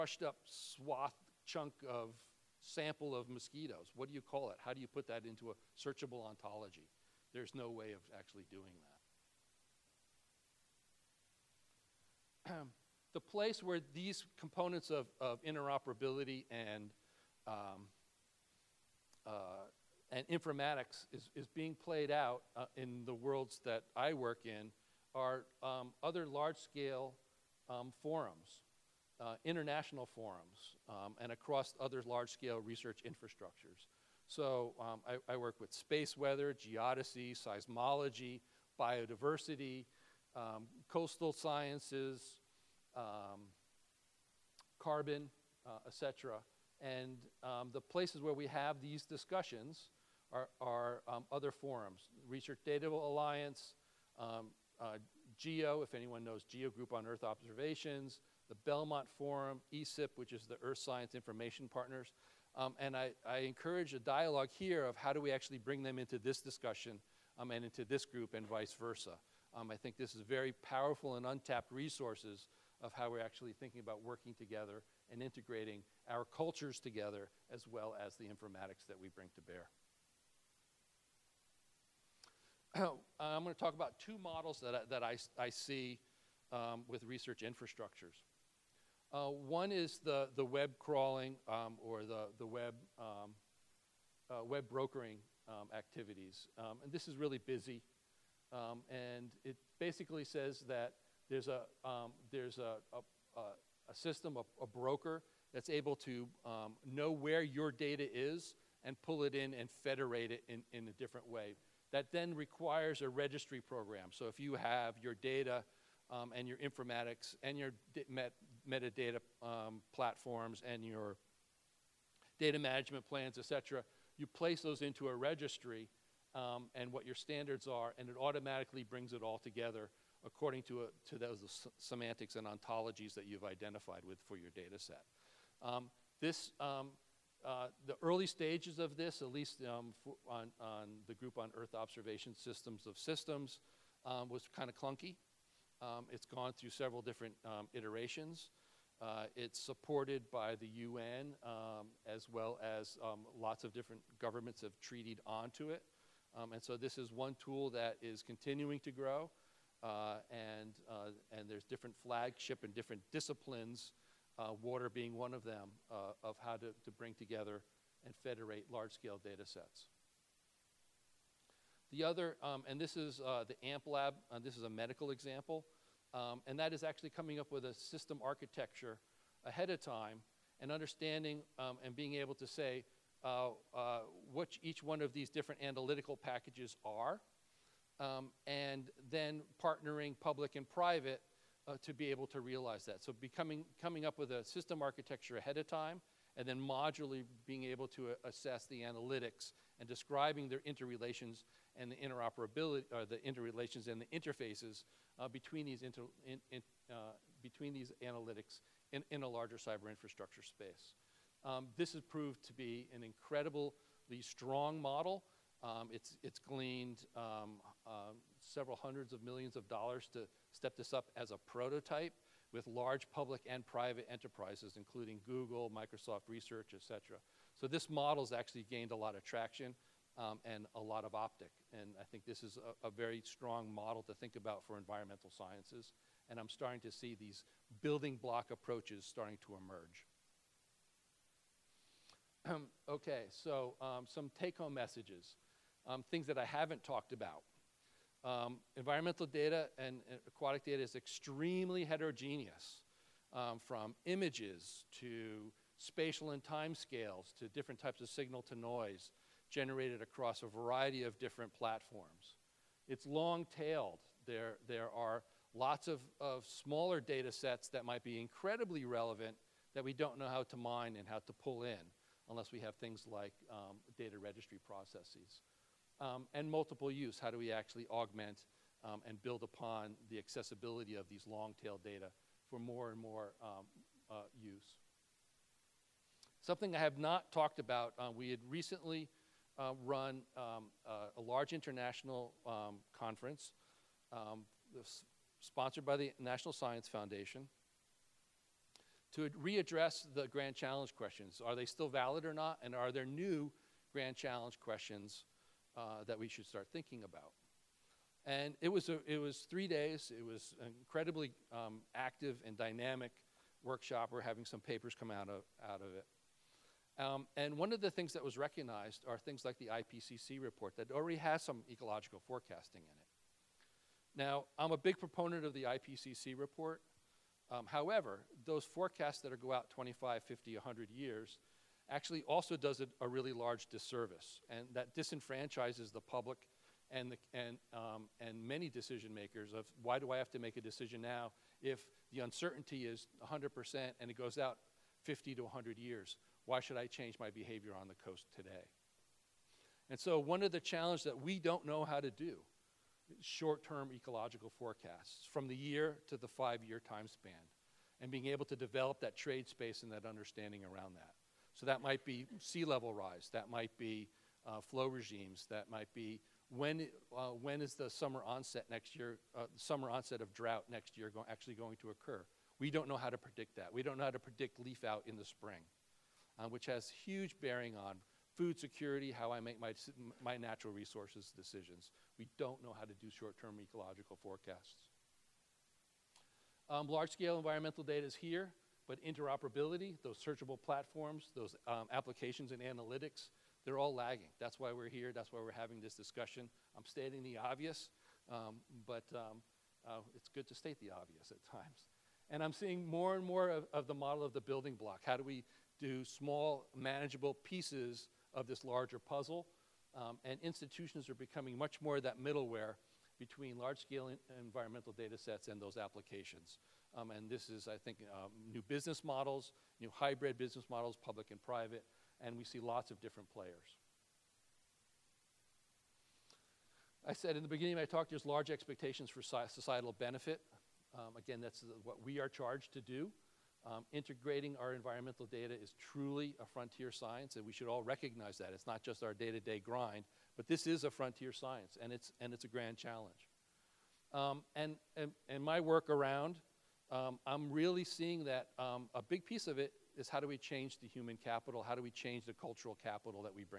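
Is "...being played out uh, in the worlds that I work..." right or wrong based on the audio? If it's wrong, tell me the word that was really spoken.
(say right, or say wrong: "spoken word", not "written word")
right.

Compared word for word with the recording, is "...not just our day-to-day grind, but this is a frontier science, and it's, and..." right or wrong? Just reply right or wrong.
right.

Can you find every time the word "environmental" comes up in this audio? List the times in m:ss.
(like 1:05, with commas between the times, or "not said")
3:54, 4:08, 6:27, 6:54, 7:14.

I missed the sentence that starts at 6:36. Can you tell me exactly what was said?
I'm stating the obvious, um, but um, uh, it's good to state the obvious at times.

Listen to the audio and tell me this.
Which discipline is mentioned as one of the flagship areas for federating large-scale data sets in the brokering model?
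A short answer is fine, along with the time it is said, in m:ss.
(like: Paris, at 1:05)
water, at 2:44.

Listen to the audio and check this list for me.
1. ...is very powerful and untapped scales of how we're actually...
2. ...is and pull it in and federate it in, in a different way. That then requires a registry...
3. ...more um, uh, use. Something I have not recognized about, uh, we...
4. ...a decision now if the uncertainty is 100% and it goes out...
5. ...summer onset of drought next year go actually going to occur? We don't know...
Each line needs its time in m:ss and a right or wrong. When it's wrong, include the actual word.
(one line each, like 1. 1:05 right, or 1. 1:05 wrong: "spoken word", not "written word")
1. 1:10 wrong: "resources", not "scales"
2. 1:48 right
3. 4:42 wrong: "talked", not "recognized"
4. 5:40 right
5. 6:09 right.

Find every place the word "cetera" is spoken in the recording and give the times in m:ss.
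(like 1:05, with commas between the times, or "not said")
2:03, 3:46.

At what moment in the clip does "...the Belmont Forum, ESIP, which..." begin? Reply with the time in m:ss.
0:58.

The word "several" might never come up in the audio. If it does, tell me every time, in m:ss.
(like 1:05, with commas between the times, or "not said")
2:26, 3:38.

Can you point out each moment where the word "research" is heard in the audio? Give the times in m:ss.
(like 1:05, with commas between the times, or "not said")
0:32, 0:52, 1:27, 3:46.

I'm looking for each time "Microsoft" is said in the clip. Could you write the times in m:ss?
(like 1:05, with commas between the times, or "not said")
3:45.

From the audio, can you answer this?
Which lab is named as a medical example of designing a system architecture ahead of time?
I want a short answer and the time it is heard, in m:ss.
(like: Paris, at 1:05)
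AMP lab, at 2:53.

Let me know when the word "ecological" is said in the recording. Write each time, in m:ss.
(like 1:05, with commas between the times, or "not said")
5:21, 5:53, 6:23.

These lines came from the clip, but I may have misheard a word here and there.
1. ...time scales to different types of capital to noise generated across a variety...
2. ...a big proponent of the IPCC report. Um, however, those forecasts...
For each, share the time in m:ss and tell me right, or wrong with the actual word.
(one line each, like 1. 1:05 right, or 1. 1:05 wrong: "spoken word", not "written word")
1. 4:16 wrong: "signal", not "capital"
2. 5:24 right.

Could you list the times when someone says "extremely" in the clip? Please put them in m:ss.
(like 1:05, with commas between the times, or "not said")
4:10.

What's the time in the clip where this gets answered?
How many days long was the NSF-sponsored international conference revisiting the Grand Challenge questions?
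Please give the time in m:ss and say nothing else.
5:09.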